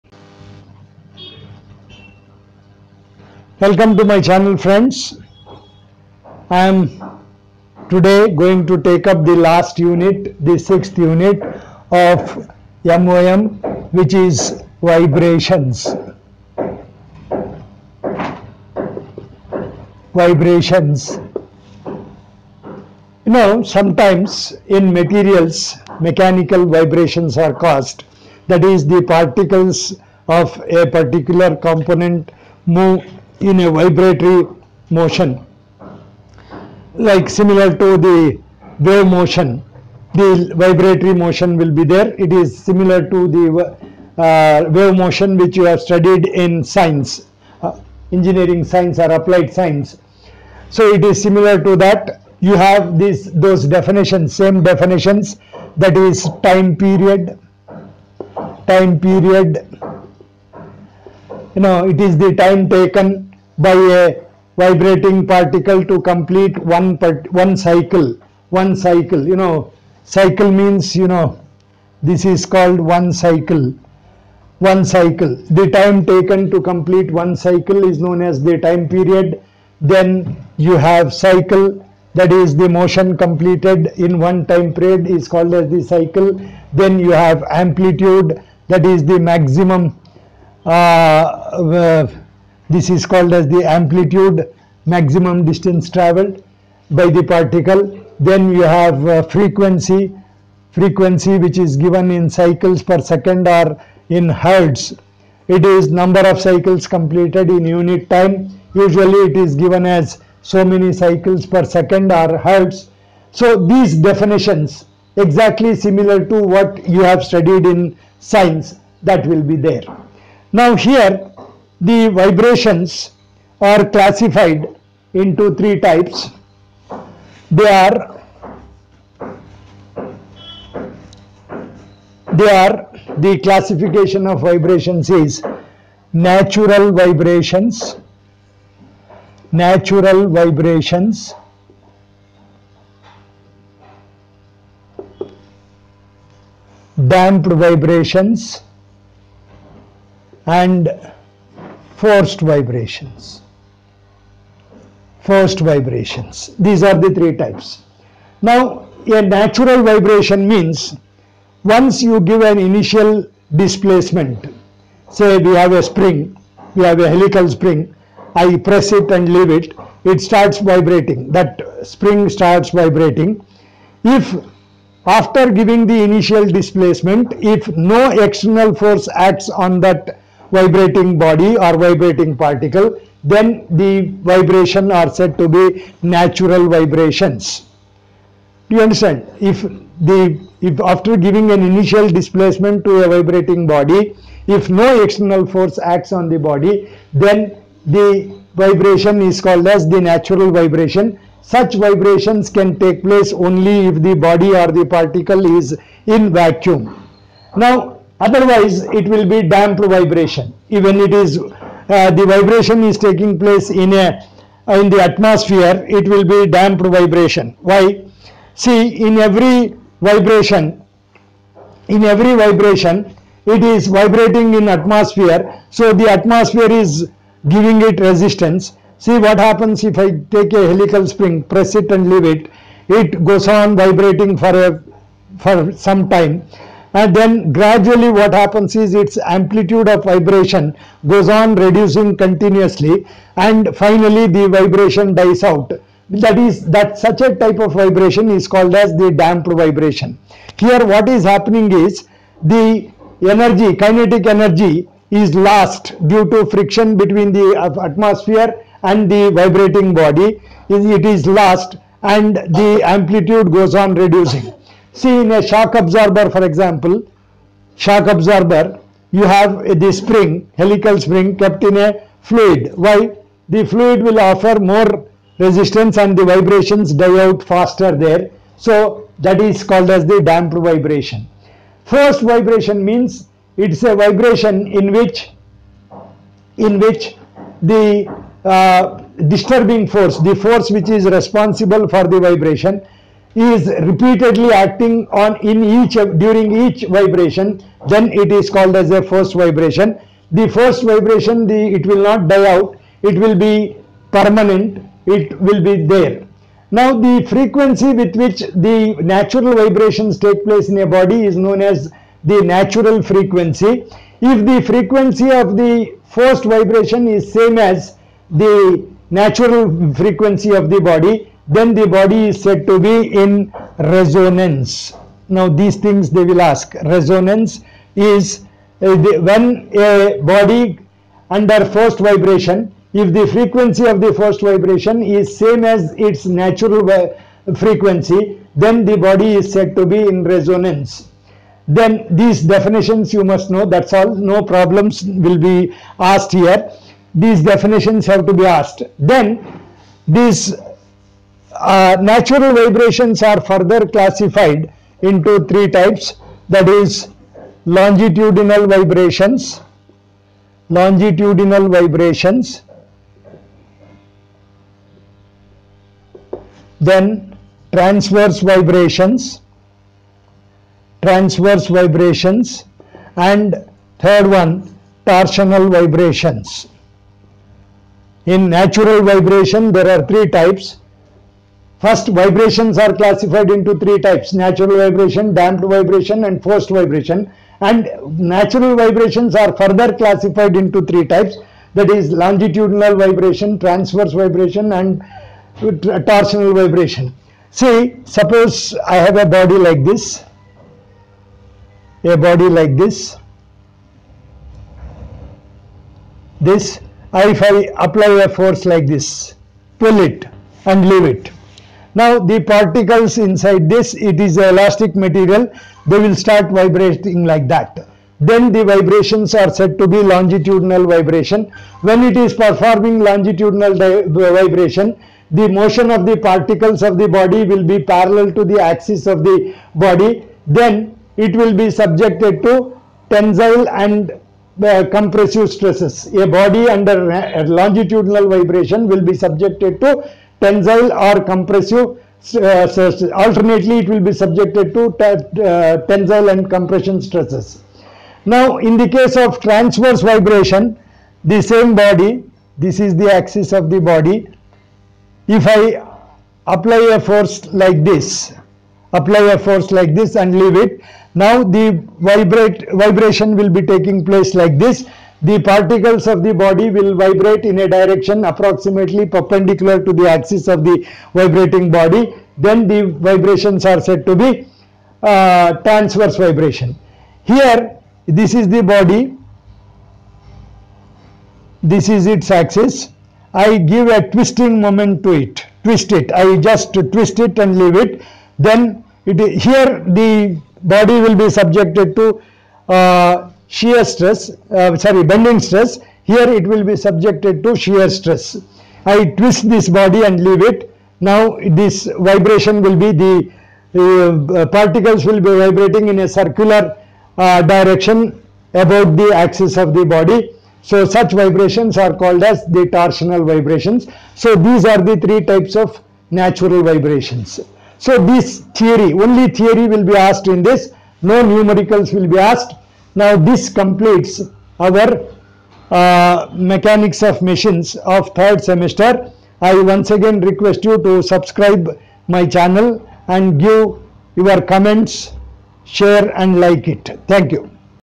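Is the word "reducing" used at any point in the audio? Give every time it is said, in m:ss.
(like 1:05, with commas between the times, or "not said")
4:01, 4:23.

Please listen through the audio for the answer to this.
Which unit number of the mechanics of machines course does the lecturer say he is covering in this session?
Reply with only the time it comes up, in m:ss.
0:10.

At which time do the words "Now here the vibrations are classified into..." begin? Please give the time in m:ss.
2:00.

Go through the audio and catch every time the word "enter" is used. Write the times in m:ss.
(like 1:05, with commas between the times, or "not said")
not said.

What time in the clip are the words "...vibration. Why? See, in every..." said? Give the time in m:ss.
3:36.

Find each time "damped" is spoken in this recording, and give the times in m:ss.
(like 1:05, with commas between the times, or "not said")
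2:27, 3:29, 3:36, 4:09, 4:40, 6:25.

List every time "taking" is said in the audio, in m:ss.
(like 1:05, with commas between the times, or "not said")
3:32, 7:43.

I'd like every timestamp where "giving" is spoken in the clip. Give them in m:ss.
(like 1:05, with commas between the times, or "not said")
2:55, 3:11, 3:47.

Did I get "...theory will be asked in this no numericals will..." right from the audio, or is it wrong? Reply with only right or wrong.
right.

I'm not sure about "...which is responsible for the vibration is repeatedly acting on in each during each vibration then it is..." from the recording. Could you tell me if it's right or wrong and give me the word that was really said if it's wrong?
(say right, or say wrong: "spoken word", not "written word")
right.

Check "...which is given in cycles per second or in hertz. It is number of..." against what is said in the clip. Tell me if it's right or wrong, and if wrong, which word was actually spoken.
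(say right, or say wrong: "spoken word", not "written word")
right.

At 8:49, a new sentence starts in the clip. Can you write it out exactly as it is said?
I once again request you to subscribe my channel and give your comments, share and like it.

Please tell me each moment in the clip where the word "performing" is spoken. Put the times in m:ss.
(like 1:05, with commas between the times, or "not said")
7:02.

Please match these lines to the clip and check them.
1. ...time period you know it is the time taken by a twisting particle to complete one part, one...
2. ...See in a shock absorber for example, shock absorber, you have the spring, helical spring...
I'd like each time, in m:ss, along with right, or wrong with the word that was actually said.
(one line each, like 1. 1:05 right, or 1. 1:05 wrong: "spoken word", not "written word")
1. 0:58 wrong: "vibrating", not "twisting"
2. 4:24 right.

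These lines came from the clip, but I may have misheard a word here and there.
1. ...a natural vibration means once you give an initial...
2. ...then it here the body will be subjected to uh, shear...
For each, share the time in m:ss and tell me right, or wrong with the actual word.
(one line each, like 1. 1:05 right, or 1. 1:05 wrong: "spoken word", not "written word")
1. 2:39 right
2. 8:08 right.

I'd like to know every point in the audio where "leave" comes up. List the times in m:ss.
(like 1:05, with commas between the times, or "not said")
2:49, 3:52, 6:50, 7:40, 8:07, 8:20.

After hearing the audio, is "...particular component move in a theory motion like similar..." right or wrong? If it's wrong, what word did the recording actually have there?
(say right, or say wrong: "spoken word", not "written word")
wrong: "vibratory", not "theory".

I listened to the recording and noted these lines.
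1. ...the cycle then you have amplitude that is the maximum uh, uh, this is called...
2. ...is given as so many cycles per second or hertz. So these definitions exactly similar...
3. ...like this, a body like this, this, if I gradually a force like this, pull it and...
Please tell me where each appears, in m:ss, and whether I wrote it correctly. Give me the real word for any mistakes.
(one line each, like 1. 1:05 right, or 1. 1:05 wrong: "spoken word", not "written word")
1. 1:25 right
2. 1:49 right
3. 6:39 wrong: "apply", not "gradually".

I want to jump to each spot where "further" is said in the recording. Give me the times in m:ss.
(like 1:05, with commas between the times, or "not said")
5:53, 6:29.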